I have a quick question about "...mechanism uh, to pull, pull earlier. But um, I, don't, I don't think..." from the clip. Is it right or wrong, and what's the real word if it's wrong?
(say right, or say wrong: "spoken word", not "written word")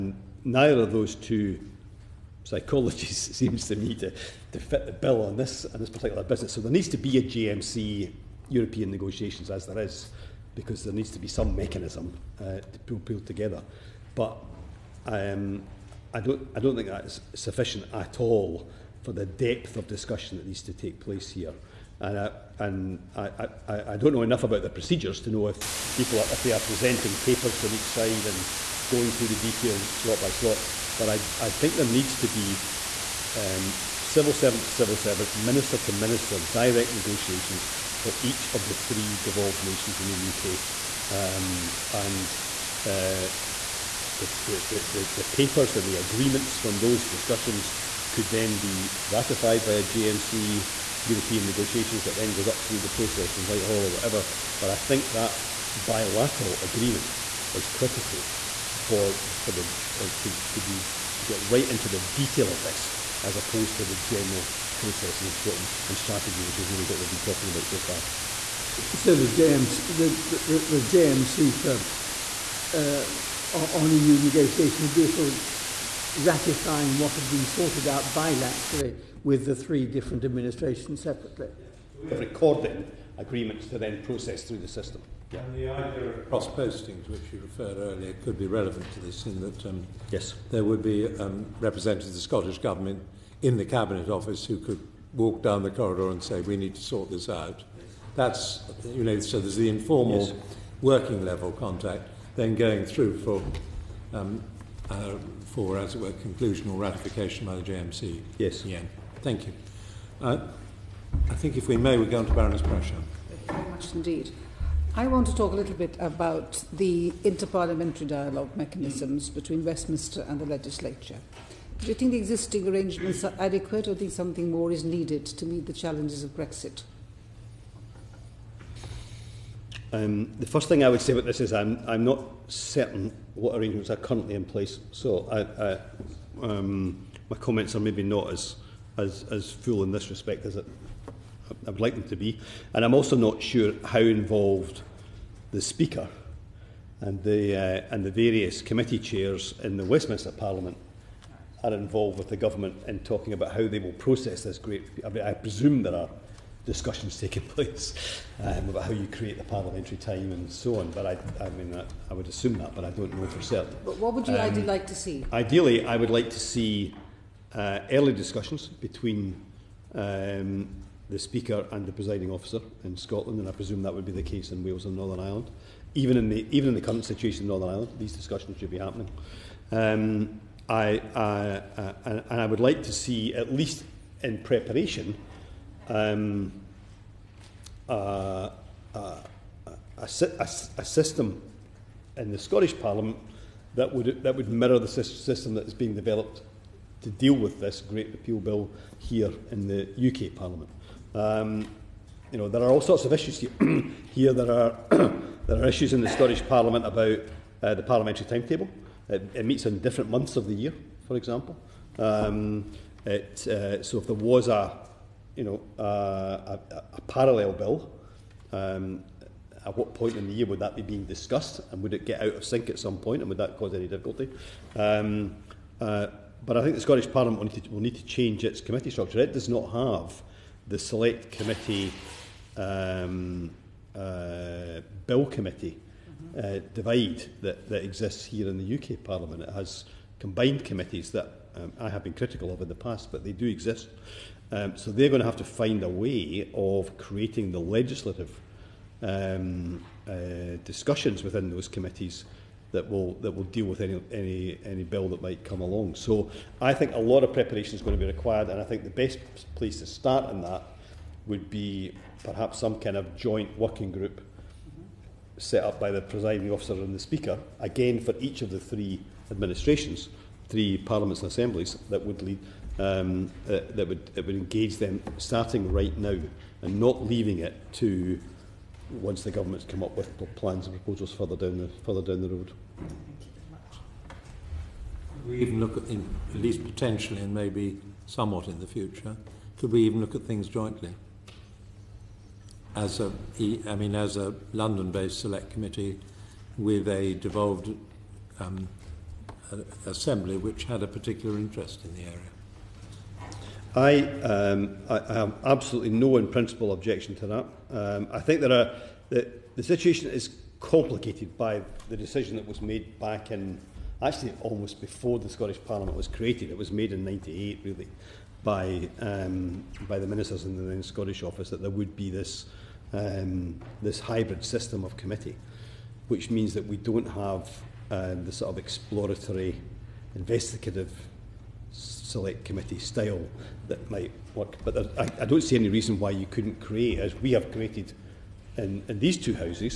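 wrong: "together", not "earlier".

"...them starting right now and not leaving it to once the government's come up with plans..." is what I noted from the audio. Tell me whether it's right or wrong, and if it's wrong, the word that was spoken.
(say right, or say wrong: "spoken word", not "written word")
right.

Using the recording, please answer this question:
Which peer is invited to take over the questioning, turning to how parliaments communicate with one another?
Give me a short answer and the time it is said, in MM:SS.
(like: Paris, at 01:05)
Baroness Prashar, at 01:52.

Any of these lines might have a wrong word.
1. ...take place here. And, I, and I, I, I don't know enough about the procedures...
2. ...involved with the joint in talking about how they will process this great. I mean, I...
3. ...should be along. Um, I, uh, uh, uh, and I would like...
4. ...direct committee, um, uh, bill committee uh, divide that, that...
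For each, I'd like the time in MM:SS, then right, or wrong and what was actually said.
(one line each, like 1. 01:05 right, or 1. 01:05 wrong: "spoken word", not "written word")
1. 00:20 right
2. 02:31 wrong: "government", not "joint"
3. 02:58 wrong: "happening", not "along"
4. 03:50 wrong: "select", not "direct".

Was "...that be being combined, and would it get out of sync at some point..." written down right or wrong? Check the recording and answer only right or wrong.
wrong.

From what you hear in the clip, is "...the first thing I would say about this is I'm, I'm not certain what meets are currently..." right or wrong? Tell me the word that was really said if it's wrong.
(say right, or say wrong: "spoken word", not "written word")
wrong: "arrangements", not "meets".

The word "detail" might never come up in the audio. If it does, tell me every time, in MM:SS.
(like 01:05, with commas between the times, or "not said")
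00:29, 01:01.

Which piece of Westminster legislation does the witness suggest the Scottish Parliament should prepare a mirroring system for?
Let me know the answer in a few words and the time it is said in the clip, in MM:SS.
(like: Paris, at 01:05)
Great Repeal Bill, at 03:17.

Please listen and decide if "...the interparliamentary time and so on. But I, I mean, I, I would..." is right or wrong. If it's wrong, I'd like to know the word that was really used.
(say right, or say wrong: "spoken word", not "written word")
wrong: "parliamentary", not "interparliamentary".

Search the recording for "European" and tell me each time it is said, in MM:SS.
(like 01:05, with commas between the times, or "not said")
00:08, 00:51.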